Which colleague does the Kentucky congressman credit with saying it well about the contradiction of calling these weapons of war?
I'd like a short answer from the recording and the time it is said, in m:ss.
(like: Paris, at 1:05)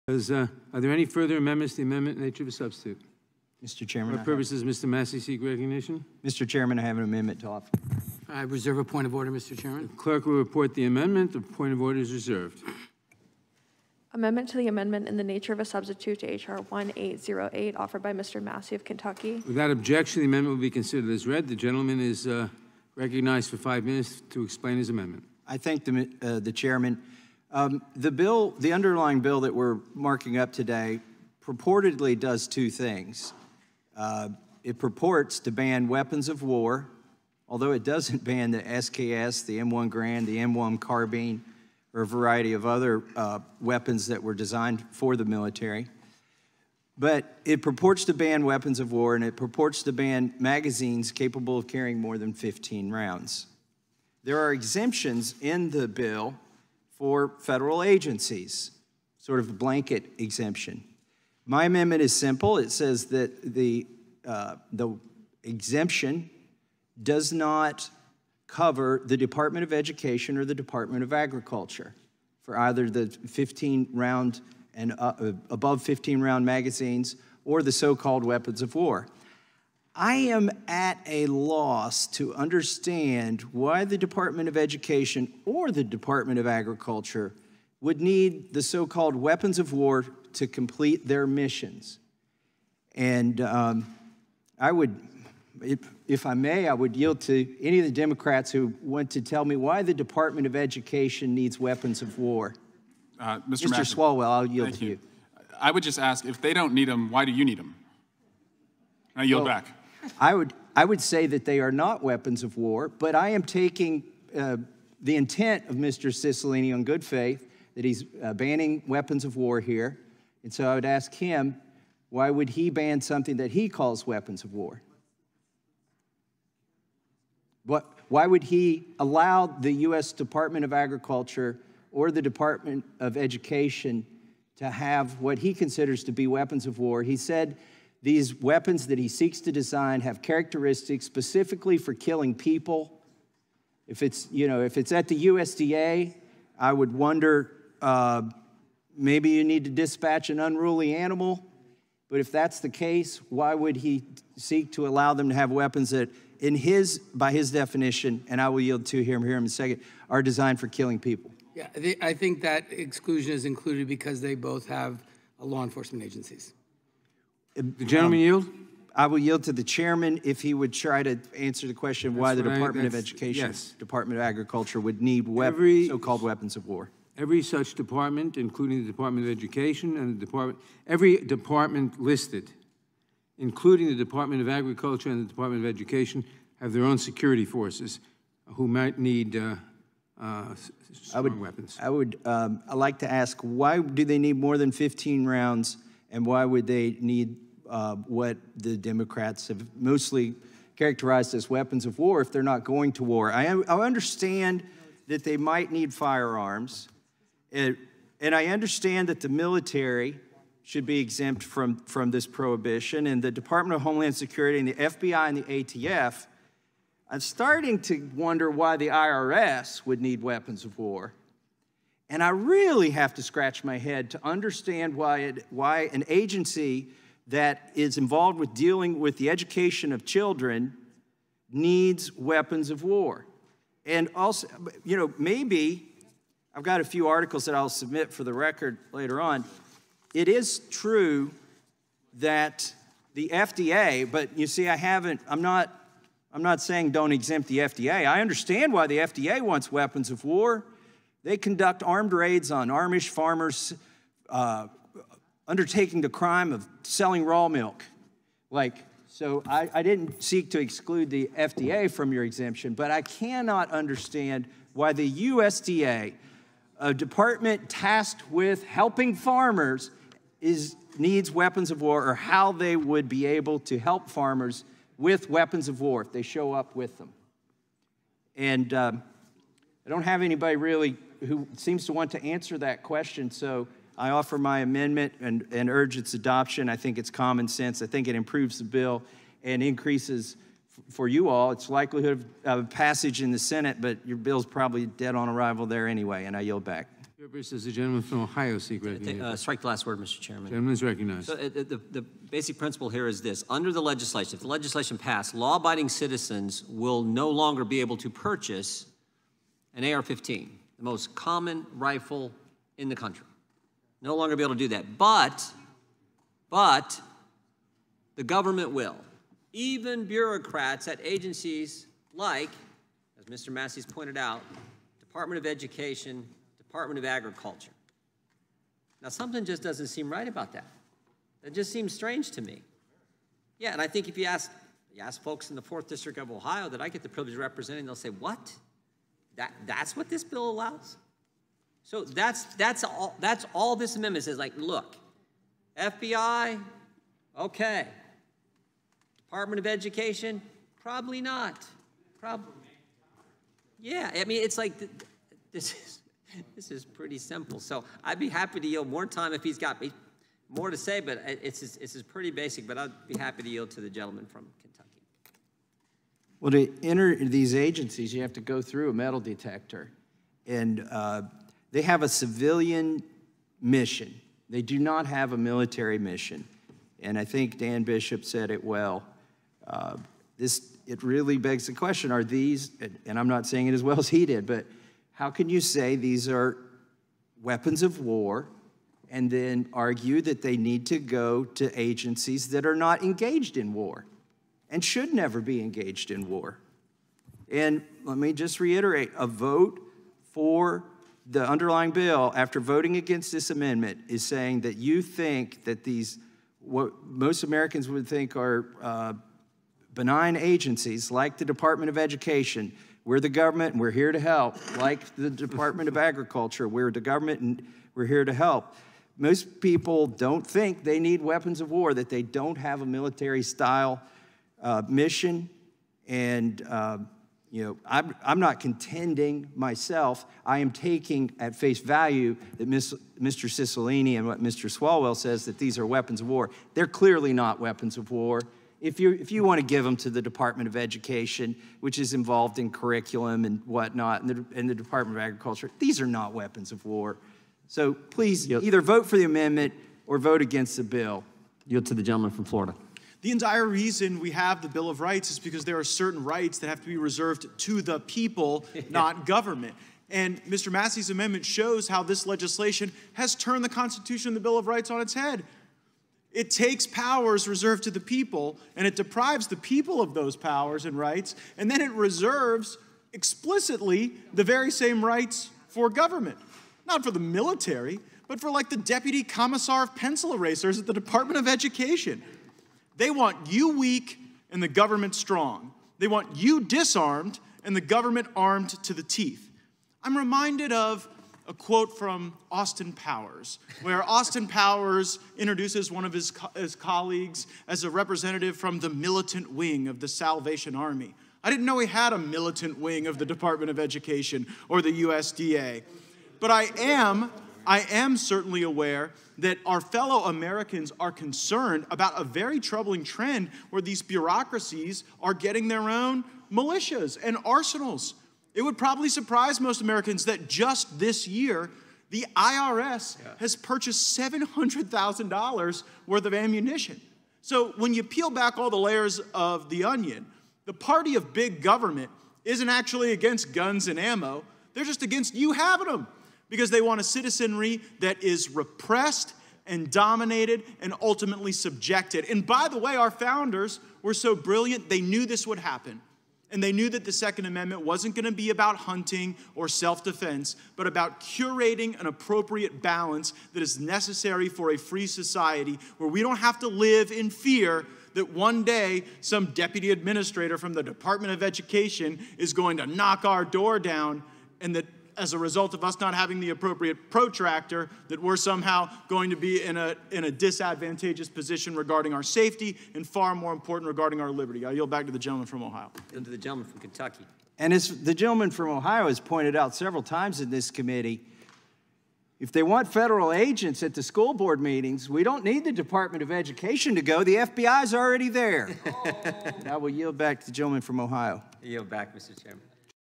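Dan Bishop, at 6:17.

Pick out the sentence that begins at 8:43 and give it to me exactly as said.
has purchased $700,000 worth of ammunition.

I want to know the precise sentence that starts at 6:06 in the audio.
Well, to enter these agencies, you have to go through a metal detector, and uh, they have a civilian mission.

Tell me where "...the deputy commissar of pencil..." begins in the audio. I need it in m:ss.
7:58.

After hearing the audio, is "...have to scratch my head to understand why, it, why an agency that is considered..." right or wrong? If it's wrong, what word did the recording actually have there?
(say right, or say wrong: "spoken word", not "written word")
wrong: "involved", not "considered".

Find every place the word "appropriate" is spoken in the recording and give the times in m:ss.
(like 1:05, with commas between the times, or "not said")
9:12, 9:26.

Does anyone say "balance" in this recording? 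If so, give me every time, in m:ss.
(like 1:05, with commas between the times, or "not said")
9:12.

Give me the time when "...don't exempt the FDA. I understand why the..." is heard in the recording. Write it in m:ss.
4:06.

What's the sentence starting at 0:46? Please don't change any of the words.
But it purports to ban weapons of war and it purports to ban magazines capable of carrying more than 15 rounds.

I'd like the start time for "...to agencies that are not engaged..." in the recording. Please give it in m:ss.
6:31.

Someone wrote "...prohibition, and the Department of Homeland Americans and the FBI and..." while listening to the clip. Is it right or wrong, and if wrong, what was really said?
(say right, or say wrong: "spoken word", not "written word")
wrong: "Security", not "Americans".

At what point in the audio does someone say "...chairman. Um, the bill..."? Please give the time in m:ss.
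0:26.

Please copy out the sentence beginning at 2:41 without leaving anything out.
Yeah, I think that exclusion is included because they both have uh, law enforcement agencies.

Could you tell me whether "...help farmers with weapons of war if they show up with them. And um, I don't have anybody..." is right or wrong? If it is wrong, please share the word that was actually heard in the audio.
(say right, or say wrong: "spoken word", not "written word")
right.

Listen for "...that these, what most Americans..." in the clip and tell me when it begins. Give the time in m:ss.
6:45.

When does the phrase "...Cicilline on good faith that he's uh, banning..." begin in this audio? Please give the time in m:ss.
1:56.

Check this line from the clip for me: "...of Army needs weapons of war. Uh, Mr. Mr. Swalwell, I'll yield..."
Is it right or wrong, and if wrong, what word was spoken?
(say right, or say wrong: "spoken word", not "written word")
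wrong: "Education", not "Army".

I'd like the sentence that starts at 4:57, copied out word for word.
This is the gentleman from Ohio seek uh, recognition.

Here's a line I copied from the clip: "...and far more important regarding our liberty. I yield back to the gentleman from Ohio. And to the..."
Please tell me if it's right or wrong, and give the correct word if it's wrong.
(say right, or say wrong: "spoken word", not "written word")
right.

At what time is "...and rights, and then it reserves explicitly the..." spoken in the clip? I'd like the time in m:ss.
7:50.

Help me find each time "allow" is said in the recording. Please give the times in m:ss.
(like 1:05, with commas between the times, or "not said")
2:08, 2:34, 5:40.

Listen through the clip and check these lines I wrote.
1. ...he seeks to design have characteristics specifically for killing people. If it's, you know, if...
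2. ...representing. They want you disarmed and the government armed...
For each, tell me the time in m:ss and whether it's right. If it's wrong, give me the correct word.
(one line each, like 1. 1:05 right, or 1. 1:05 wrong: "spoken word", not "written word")
1. 2:18 right
2. 8:05 wrong: "strong", not "representing".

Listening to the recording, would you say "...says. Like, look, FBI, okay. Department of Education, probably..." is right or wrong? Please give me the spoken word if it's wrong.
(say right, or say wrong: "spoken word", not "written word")
right.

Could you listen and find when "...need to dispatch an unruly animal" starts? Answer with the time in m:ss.
2:29.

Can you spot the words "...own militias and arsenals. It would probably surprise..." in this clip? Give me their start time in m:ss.
8:35.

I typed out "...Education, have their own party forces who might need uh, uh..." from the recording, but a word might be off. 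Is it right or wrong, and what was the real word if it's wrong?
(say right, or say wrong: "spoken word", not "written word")
wrong: "security", not "party".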